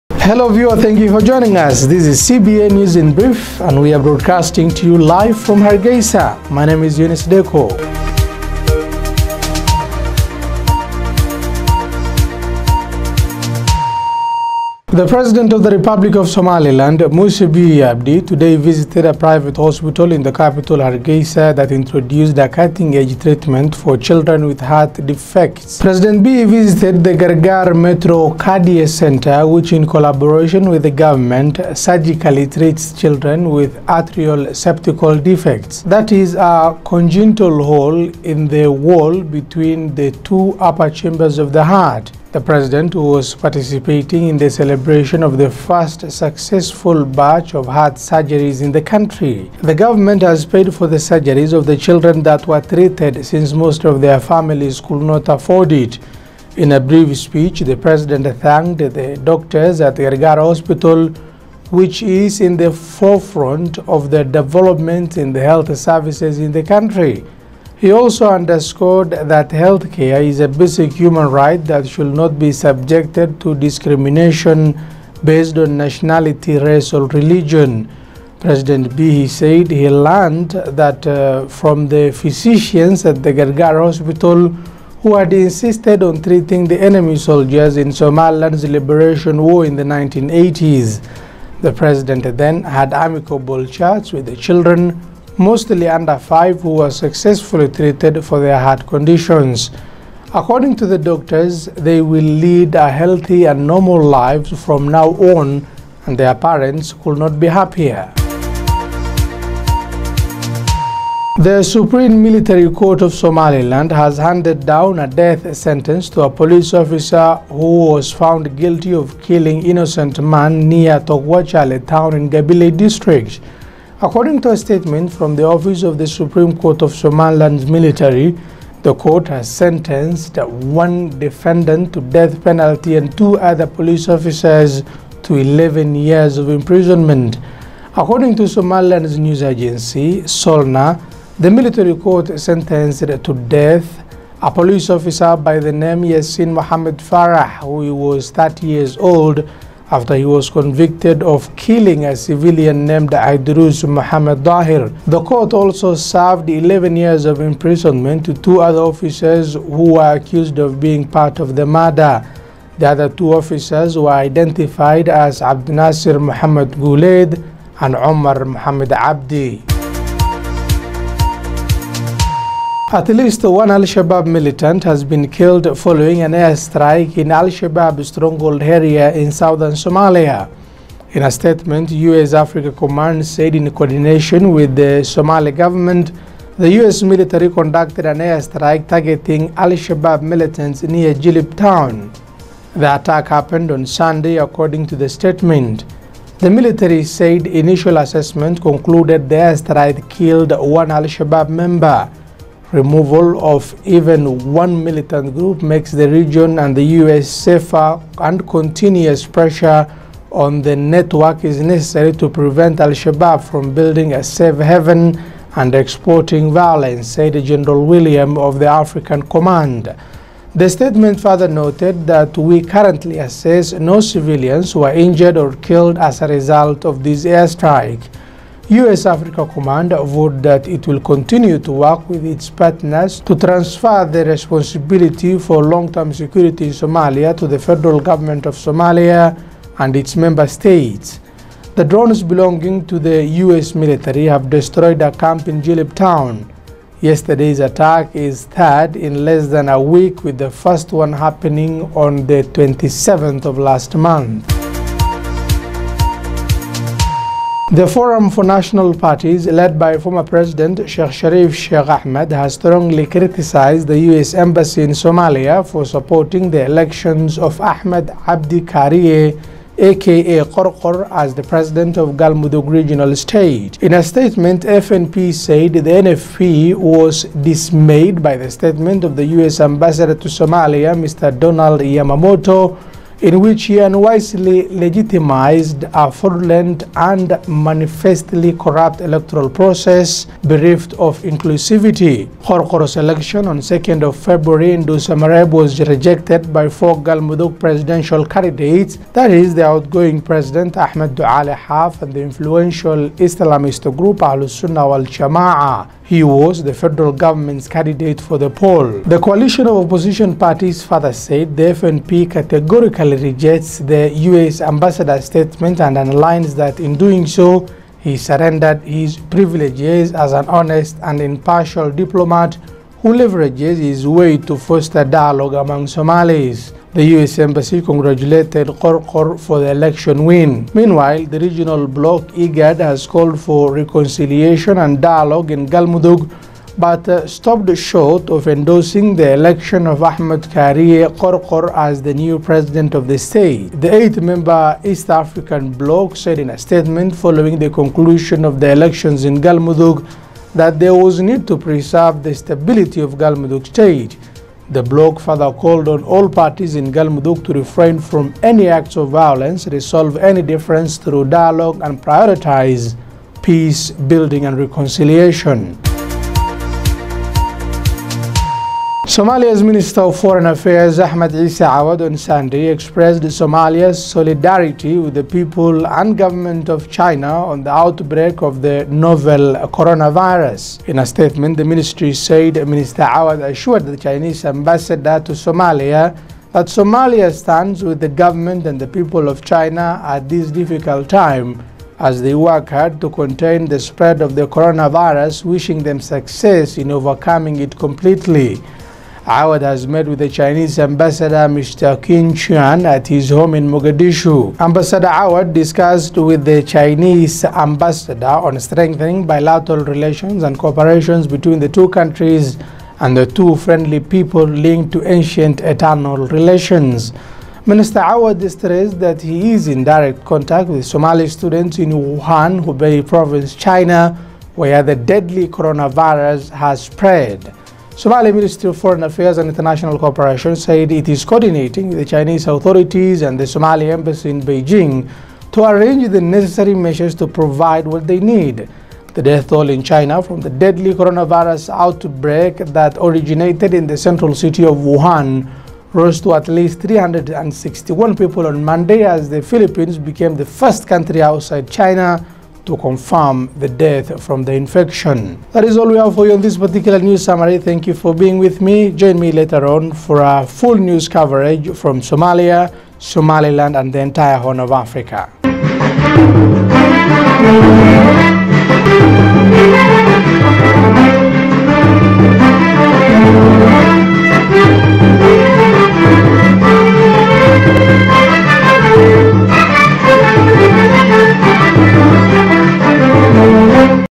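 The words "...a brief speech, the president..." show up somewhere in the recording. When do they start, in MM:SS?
00:56.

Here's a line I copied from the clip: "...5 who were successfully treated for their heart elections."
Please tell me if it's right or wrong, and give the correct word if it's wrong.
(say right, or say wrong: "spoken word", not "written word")
wrong: "conditions", not "elections".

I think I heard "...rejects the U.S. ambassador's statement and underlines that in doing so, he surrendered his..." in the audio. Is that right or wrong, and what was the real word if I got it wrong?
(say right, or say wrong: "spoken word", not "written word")
right.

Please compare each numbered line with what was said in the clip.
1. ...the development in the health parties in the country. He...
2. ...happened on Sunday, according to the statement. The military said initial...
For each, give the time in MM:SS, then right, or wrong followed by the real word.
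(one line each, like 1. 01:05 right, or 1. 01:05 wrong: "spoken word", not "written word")
1. 01:04 wrong: "services", not "parties"
2. 03:13 right.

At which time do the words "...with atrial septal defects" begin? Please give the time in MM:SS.
00:33.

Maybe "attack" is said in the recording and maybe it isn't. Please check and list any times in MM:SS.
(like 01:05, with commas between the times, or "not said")
03:12, 04:07.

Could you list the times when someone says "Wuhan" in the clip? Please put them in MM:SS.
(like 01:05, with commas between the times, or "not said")
07:01, 07:24.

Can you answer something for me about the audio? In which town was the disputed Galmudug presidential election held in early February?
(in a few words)
Dhuusamareeb.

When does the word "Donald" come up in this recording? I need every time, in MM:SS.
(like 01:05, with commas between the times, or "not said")
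04:41.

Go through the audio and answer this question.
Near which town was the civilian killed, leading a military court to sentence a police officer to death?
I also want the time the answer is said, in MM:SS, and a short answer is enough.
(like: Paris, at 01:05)
Tog Wajaale, at 02:00.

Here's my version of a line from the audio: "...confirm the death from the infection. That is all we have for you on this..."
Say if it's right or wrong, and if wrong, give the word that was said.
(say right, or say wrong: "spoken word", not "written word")
right.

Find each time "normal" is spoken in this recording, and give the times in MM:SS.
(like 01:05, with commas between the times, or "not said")
01:43.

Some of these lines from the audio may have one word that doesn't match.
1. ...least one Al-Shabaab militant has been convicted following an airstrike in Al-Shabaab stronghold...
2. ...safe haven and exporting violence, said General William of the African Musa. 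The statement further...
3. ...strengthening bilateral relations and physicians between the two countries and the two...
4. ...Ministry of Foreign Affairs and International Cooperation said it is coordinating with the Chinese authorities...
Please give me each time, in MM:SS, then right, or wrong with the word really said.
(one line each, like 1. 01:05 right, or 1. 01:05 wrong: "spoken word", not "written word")
1. 02:53 wrong: "killed", not "convicted"
2. 03:34 wrong: "Command", not "Musa"
3. 06:48 wrong: "cooperations", not "physicians"
4. 07:08 right.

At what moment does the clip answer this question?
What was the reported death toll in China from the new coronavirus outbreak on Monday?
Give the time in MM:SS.
07:26.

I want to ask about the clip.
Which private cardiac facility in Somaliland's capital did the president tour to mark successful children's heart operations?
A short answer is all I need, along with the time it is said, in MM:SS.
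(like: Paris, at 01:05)
Gargar Metro Cardia Center, at 00:27.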